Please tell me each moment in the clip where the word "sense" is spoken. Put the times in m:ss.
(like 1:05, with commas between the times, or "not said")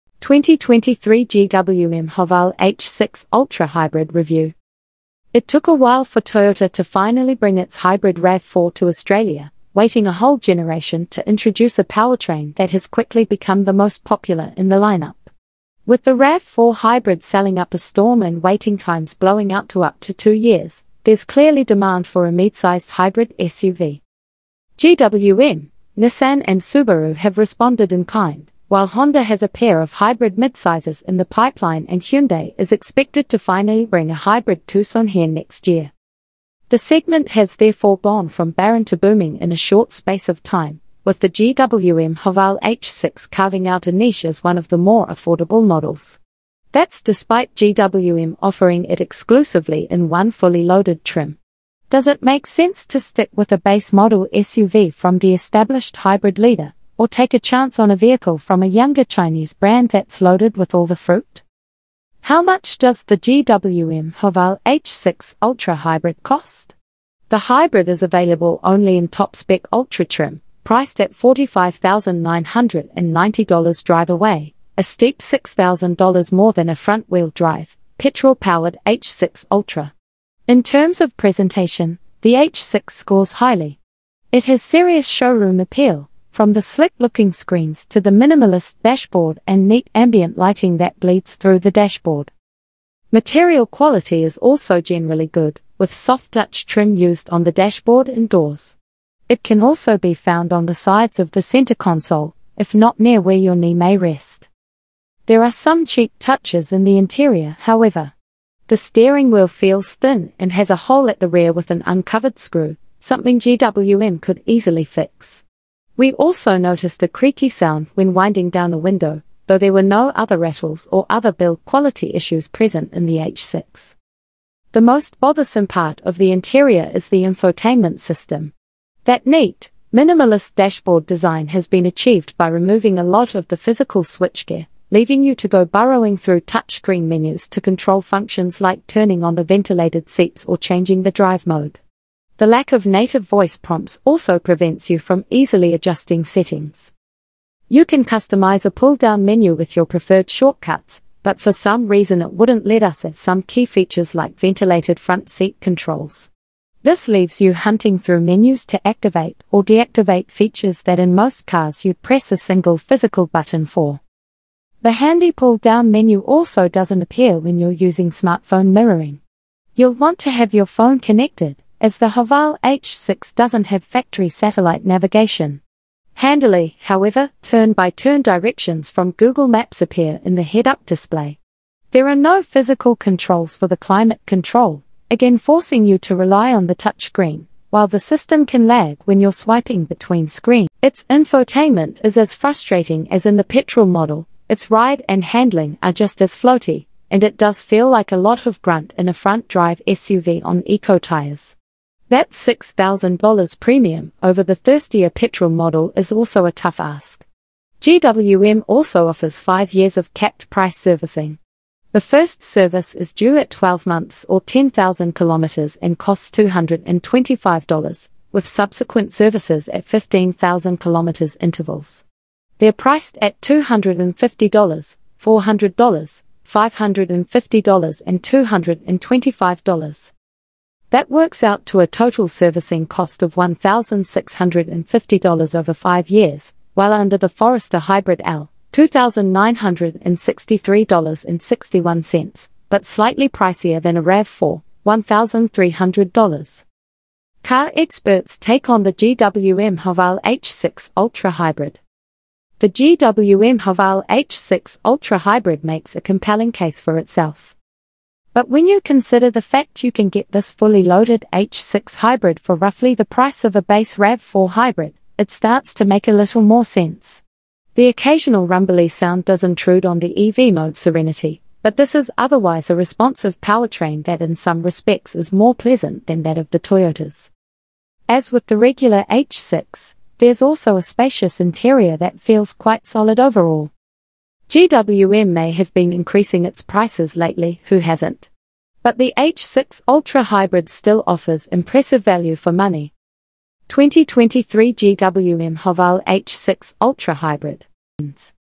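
0:52, 4:26.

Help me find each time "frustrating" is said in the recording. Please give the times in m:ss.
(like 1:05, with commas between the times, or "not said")
3:12.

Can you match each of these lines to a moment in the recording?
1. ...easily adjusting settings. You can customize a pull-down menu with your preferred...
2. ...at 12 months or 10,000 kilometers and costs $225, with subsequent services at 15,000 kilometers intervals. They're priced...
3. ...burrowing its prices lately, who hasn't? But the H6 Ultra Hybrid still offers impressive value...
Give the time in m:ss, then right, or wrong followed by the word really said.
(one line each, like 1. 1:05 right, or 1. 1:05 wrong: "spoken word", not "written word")
1. 2:25 right
2. 3:33 right
3. 4:45 wrong: "increasing", not "burrowing".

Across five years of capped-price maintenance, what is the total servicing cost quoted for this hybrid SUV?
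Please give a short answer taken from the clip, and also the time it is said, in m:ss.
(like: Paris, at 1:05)
$1,650, at 3:53.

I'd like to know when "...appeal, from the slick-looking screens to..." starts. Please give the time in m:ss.
1:25.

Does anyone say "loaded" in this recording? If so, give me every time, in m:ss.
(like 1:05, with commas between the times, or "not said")
0:50, 1:00, 4:20.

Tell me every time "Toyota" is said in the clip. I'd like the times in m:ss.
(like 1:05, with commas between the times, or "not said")
0:06, 4:36.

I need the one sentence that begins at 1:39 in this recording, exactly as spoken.
It can also be found on the sides of the center console, if not near where your knee may rest.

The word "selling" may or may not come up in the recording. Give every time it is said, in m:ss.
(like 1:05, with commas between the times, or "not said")
0:17.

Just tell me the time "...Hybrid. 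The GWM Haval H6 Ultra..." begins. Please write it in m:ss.
4:11.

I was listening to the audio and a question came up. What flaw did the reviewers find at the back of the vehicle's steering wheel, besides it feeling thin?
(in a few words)
An uncovered screw.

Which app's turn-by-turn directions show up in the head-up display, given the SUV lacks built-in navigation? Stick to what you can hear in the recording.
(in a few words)
Google Maps.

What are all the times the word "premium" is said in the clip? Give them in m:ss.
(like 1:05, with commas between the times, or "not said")
3:23.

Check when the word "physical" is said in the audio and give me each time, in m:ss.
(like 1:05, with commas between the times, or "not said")
2:13, 2:42, 3:02.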